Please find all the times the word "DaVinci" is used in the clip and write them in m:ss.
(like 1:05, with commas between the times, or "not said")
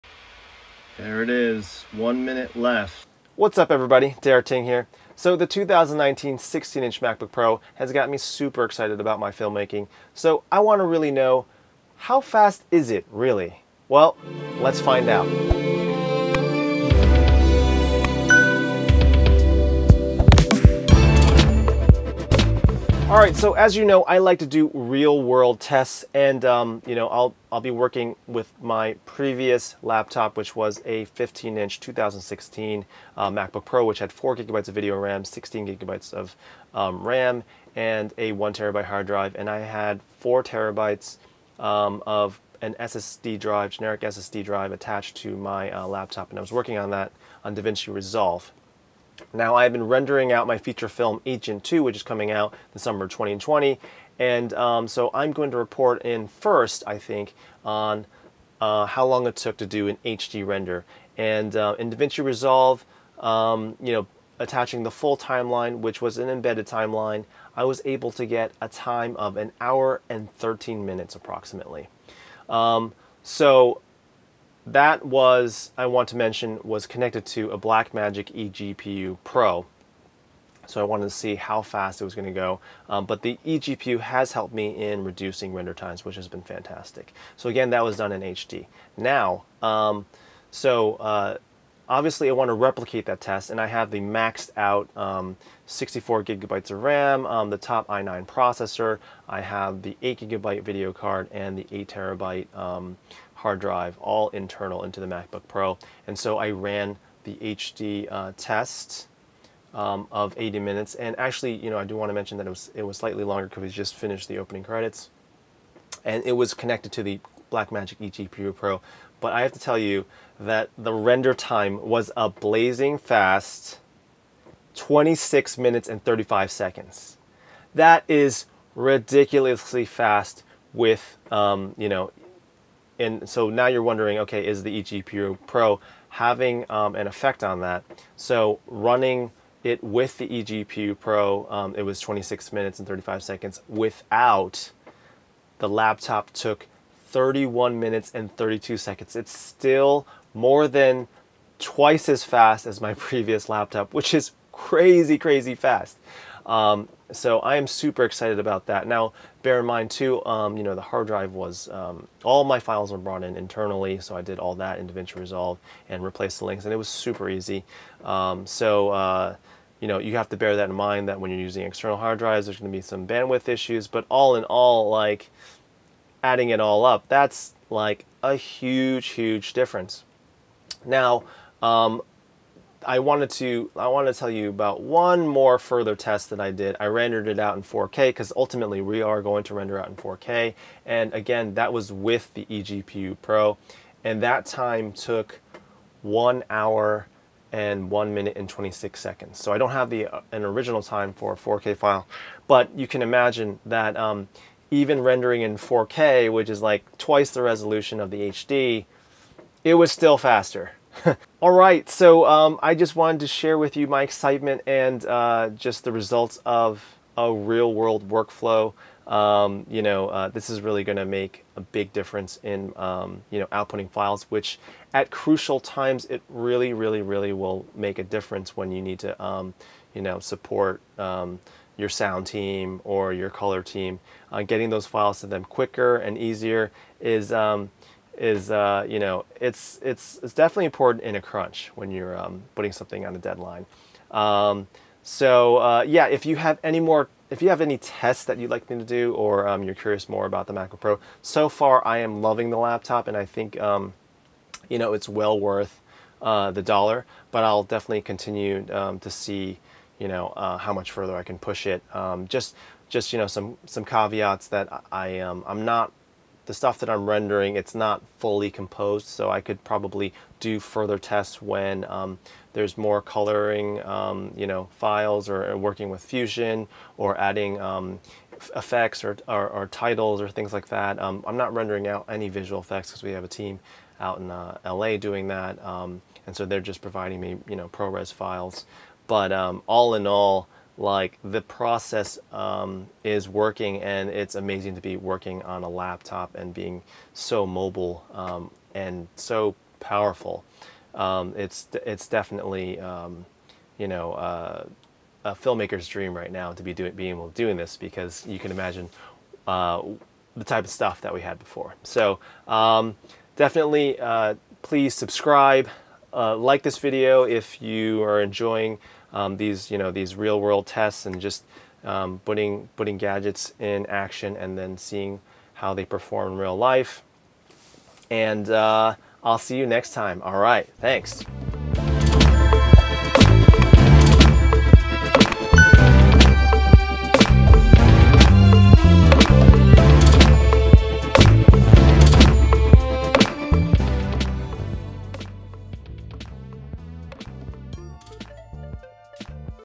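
0:47, 1:01, 2:44.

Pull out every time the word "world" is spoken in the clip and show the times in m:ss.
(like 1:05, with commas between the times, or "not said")
0:25, 3:37, 5:20.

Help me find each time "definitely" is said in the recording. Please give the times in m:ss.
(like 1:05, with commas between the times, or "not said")
4:00, 4:17, 5:02, 5:13.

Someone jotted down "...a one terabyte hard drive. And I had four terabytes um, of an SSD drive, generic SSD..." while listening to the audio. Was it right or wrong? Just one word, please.
right.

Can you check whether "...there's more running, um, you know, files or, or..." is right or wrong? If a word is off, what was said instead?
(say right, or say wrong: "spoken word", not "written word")
wrong: "coloring", not "running".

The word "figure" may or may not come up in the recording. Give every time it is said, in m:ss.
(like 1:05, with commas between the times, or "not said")
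not said.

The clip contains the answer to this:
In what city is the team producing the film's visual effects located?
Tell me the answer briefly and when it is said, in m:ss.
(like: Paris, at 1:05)
LA, at 4:44.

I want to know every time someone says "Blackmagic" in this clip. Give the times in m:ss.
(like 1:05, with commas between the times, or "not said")
1:17, 1:57.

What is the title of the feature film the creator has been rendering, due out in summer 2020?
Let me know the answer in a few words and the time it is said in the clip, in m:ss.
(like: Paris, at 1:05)
Agent 2, at 0:51.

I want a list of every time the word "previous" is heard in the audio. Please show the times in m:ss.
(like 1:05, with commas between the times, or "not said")
0:29, 2:32.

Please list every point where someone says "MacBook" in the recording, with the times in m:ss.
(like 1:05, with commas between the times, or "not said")
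0:07, 0:33, 1:45, 4:10.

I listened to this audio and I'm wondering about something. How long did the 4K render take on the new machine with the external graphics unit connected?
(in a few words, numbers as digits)
1 hour 1 minute 26 seconds.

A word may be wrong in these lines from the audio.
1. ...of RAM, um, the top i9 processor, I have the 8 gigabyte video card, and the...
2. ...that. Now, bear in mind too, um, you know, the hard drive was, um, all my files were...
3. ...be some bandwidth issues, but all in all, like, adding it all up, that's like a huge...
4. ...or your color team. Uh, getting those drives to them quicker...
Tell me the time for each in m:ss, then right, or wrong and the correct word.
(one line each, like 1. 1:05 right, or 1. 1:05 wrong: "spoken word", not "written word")
1. 1:36 right
2. 2:38 right
3. 2:52 right
4. 3:52 wrong: "files", not "drives".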